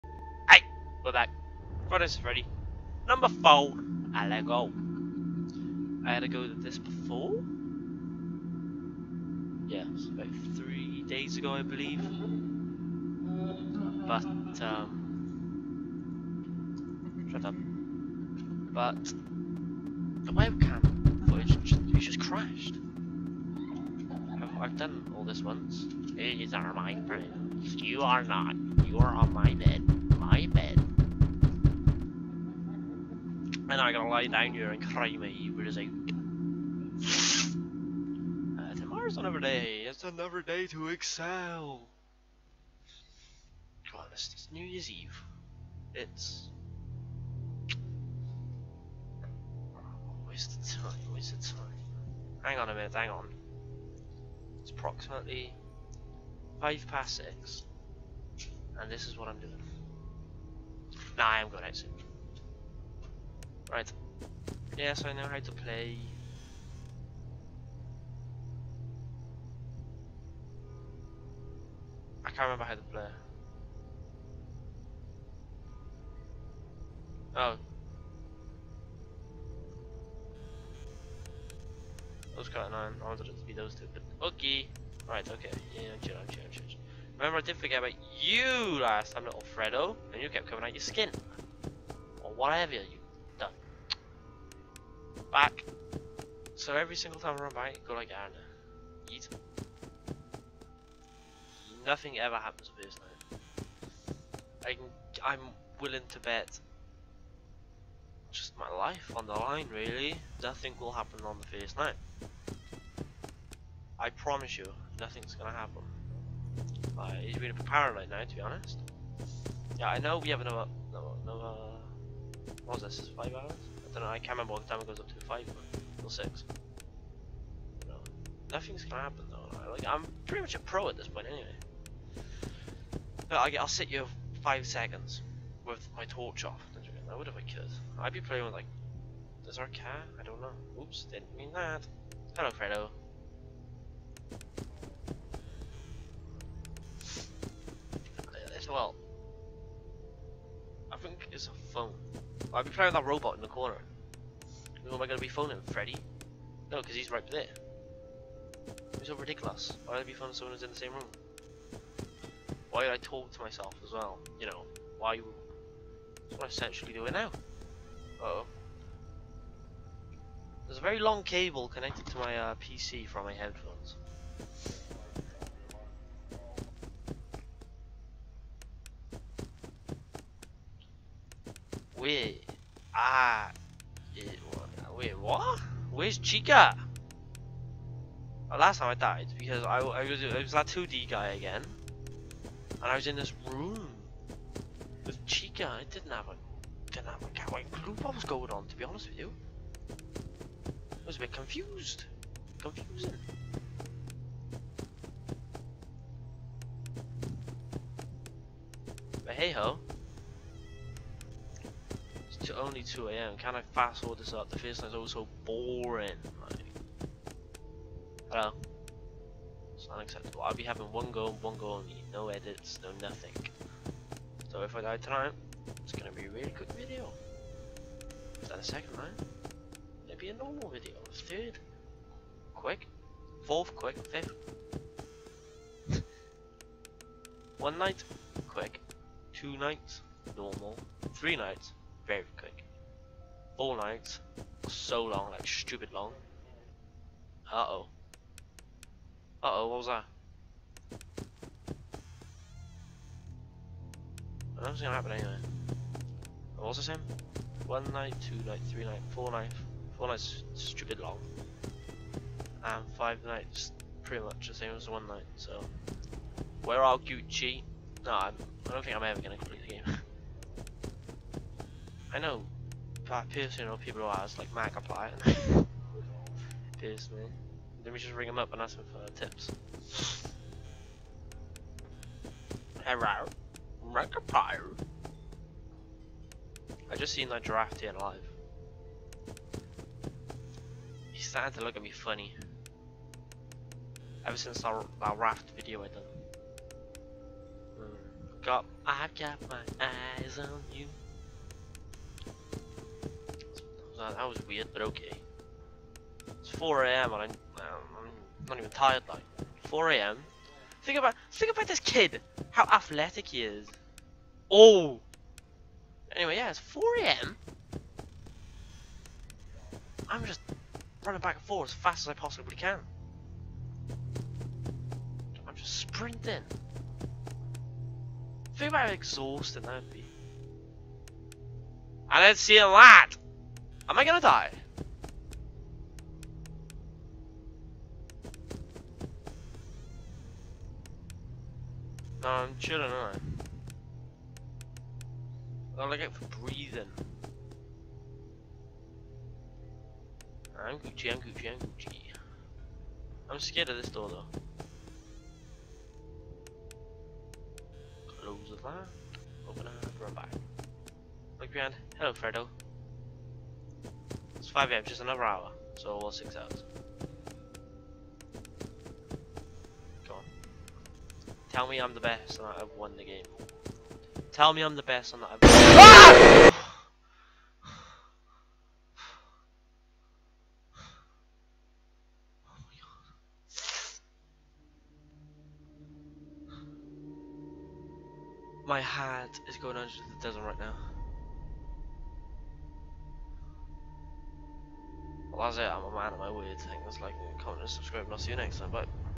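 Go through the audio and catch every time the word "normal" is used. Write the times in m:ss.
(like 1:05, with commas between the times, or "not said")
3:50, 4:00.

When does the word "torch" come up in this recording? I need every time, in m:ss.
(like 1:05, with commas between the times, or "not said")
2:16.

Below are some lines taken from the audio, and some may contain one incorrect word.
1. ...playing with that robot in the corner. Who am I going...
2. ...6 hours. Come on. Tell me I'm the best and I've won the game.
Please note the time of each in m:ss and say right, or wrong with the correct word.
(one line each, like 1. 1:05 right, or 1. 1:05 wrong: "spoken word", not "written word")
1. 2:32 right
2. 6:06 right.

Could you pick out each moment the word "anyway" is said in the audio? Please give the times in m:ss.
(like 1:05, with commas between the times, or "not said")
2:11, 4:15, 5:16.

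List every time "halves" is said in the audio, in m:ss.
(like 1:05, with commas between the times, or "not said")
not said.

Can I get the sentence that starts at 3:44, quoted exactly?
So if I die tonight, it's gonna be a really good video.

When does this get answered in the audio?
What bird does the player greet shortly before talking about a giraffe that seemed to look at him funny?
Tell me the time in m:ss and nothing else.
4:42.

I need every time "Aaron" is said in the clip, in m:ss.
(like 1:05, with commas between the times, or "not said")
1:38.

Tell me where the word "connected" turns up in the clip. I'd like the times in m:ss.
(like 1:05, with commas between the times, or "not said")
2:51.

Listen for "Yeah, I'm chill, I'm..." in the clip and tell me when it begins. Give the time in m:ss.
1:25.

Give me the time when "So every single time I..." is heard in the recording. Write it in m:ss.
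1:36.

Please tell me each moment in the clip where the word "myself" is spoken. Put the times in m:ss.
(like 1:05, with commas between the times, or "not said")
2:43.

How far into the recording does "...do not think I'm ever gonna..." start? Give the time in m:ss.
4:28.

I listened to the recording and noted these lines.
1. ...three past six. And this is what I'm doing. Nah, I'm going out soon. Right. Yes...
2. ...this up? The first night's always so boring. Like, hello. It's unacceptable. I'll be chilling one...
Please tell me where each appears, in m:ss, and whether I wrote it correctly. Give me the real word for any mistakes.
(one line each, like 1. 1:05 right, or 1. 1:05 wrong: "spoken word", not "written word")
1. 0:56 wrong: "five", not "three"
2. 3:34 wrong: "having", not "chilling".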